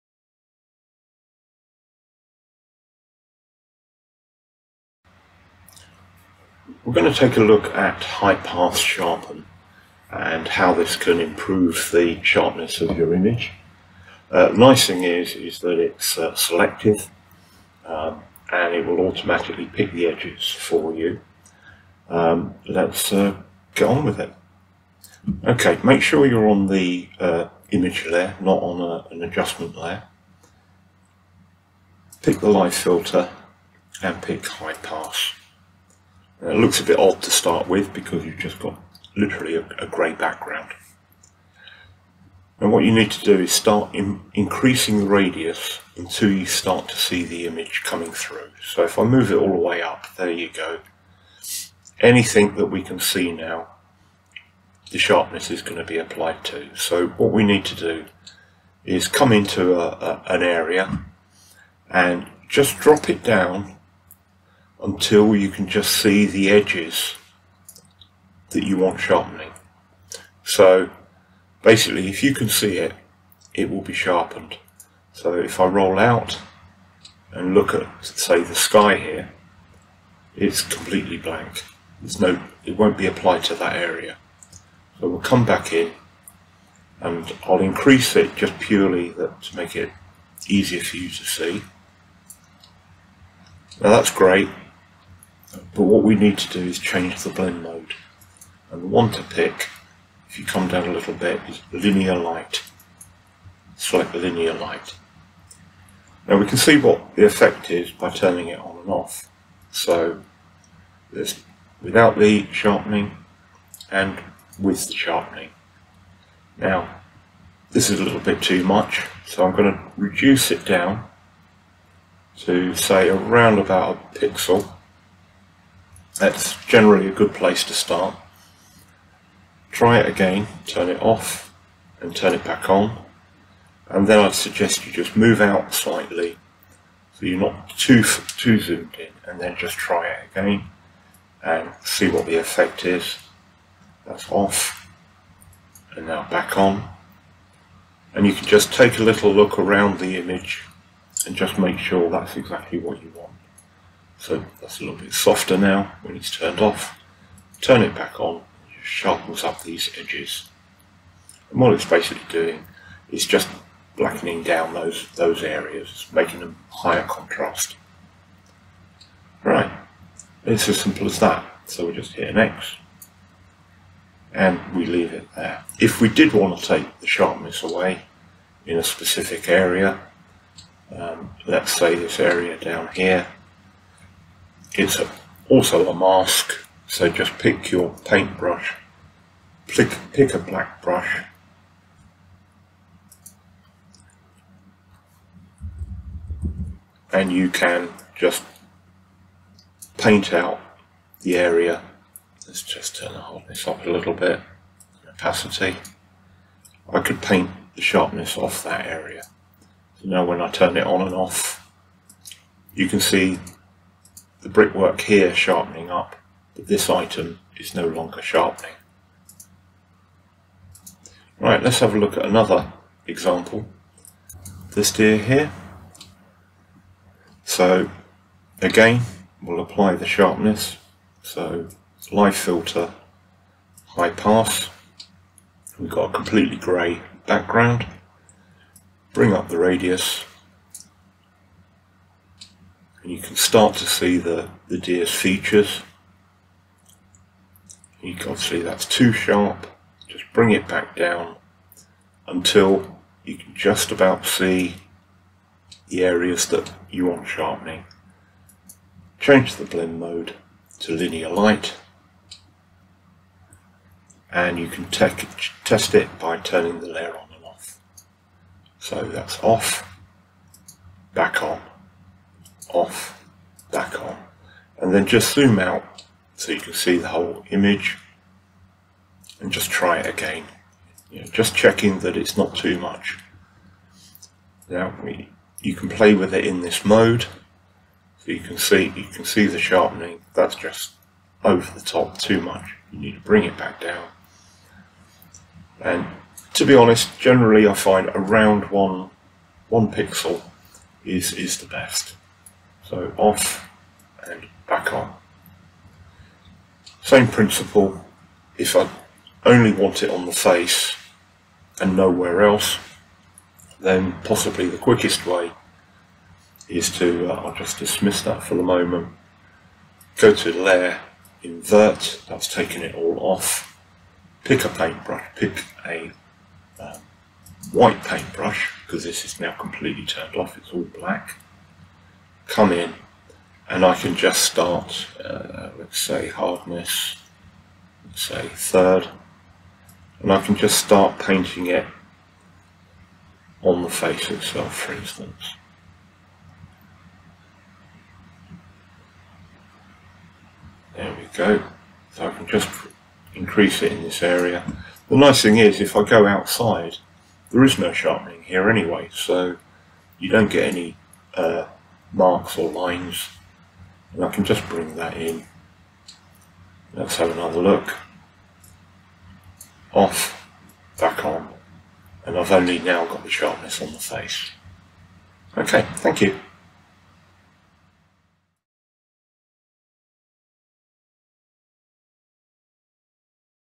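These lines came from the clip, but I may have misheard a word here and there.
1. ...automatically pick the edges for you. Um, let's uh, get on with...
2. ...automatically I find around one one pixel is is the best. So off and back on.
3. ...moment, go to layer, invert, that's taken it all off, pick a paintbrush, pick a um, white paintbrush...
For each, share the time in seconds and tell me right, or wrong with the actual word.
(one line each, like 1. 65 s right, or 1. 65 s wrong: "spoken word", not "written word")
1. 19 s right
2. 297 s wrong: "generally", not "automatically"
3. 318 s right.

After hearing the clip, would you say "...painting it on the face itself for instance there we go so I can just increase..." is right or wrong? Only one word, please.
right.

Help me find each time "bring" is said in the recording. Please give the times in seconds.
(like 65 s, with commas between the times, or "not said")
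239 s, 250 s, 293 s, 364 s.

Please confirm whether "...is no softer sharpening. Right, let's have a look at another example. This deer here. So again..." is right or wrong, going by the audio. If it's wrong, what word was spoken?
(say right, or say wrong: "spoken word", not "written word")
wrong: "longer", not "softer".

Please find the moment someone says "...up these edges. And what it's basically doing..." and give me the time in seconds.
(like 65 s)
159 s.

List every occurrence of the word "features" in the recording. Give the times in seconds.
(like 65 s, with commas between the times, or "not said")
245 s.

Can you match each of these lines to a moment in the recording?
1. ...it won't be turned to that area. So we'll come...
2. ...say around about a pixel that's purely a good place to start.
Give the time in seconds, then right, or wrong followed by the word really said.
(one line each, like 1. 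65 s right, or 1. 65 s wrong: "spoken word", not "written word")
1. 82 s wrong: "applied", not "turned"
2. 122 s wrong: "generally", not "purely".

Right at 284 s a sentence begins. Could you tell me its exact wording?
Now we, you can play with it in this mode, so you can see you can see the sharpening.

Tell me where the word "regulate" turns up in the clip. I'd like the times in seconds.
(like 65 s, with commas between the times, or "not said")
not said.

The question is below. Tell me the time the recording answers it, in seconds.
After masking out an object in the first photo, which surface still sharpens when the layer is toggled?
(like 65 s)
214 s.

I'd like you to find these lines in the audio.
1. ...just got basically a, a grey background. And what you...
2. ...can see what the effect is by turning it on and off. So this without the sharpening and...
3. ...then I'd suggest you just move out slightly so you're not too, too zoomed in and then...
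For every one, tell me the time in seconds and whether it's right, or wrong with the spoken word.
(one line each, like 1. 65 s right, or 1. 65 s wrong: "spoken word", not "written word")
1. 38 s wrong: "literally", not "basically"
2. 106 s right
3. 134 s right.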